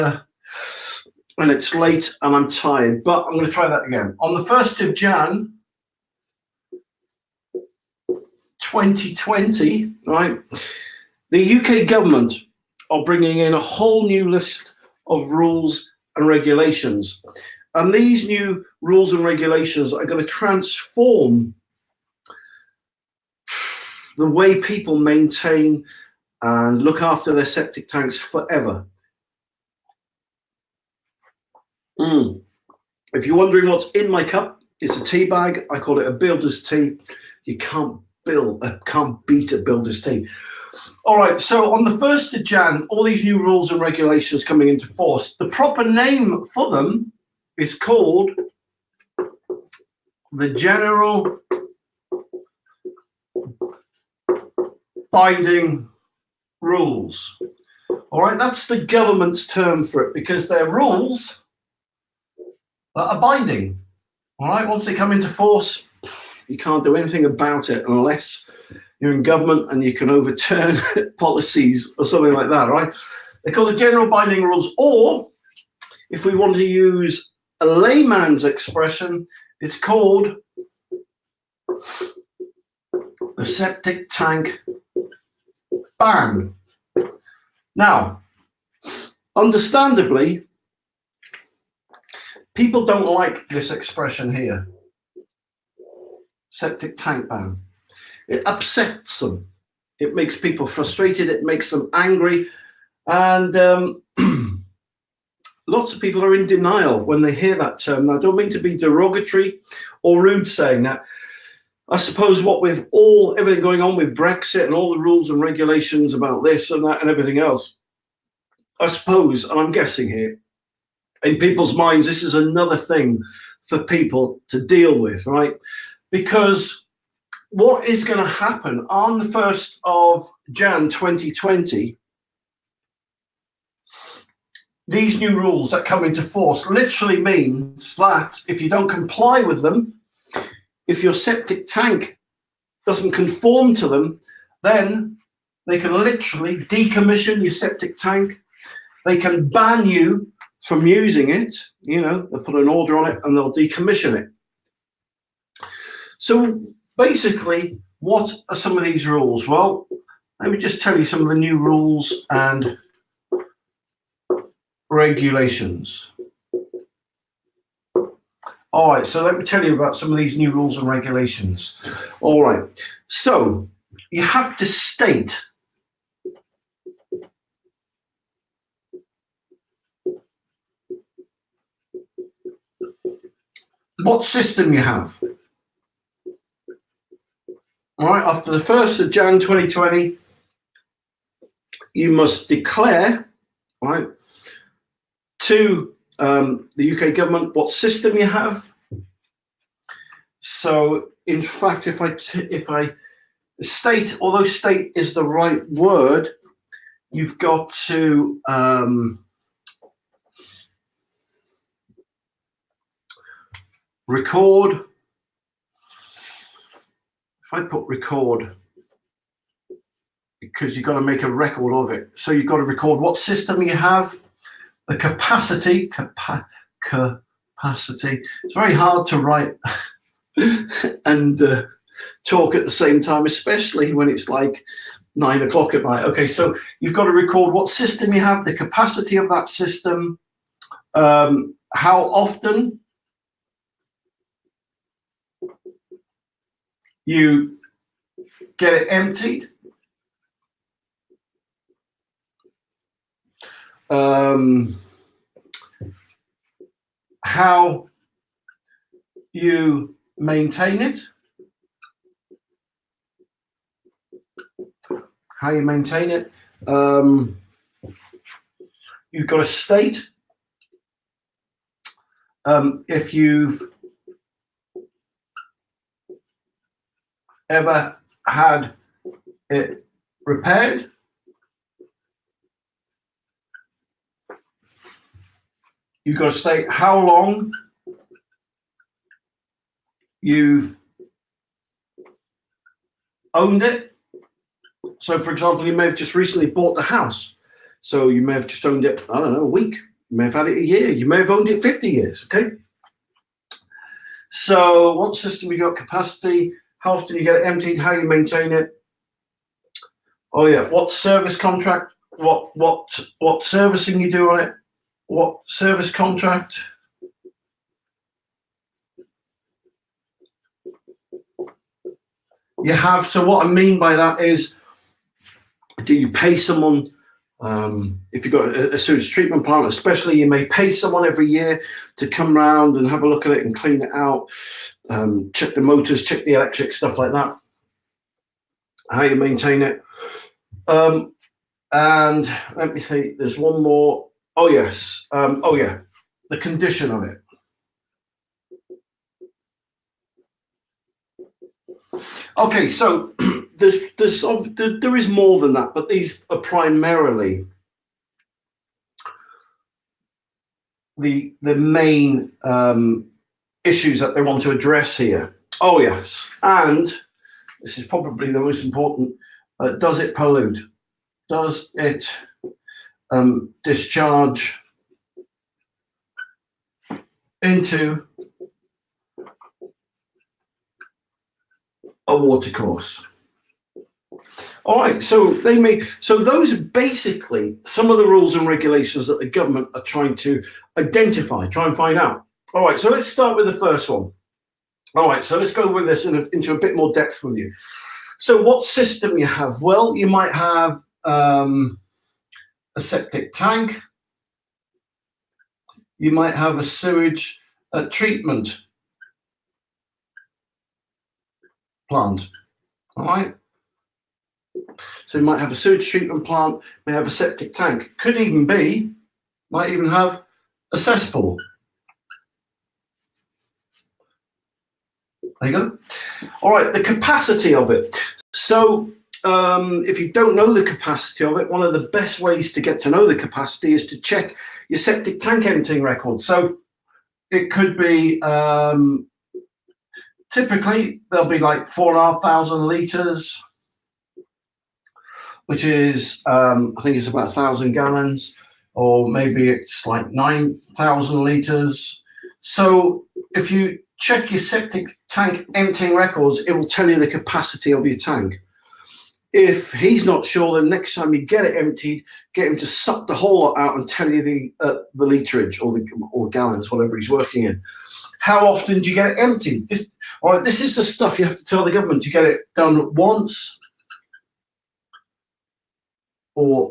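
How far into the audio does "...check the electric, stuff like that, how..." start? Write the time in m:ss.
5:36.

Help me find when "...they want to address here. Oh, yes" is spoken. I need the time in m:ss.
6:04.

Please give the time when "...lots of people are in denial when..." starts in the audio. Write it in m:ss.
1:45.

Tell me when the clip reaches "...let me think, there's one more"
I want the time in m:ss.
5:42.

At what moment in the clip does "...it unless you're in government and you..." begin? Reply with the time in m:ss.
1:07.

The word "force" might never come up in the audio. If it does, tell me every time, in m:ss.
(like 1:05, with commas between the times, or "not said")
0:44, 1:05, 2:16.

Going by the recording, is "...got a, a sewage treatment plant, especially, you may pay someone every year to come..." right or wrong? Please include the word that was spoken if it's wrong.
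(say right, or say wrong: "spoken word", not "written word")
right.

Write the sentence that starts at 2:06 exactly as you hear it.
Because what is going to happen on the 1st of Jan 2020?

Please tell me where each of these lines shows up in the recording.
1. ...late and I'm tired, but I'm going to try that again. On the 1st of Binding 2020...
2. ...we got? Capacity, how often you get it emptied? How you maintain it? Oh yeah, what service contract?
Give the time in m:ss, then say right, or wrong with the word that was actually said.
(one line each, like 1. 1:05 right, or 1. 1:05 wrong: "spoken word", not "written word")
1. 0:01 wrong: "Jan", not "Binding"
2. 5:05 right.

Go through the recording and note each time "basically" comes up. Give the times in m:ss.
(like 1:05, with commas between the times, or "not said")
2:36, 6:26.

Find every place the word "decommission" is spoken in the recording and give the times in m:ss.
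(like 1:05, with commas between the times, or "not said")
2:26, 2:33.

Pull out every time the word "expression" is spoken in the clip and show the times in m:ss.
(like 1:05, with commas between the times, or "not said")
1:18, 1:33.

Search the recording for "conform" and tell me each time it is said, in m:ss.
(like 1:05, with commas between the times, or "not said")
2:23.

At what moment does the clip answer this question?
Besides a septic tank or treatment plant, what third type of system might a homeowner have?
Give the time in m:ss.
7:00.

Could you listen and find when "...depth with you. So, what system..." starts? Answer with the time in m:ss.
6:36.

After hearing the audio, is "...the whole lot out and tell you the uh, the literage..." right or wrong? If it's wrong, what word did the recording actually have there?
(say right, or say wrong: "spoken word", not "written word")
right.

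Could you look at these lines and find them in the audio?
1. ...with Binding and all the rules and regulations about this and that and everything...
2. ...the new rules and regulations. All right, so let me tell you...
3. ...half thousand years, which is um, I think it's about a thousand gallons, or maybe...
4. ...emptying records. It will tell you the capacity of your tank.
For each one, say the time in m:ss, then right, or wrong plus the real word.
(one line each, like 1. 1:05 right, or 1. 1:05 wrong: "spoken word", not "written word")
1. 1:53 wrong: "Brexit", not "Binding"
2. 2:41 right
3. 7:22 wrong: "liters", not "years"
4. 7:35 right.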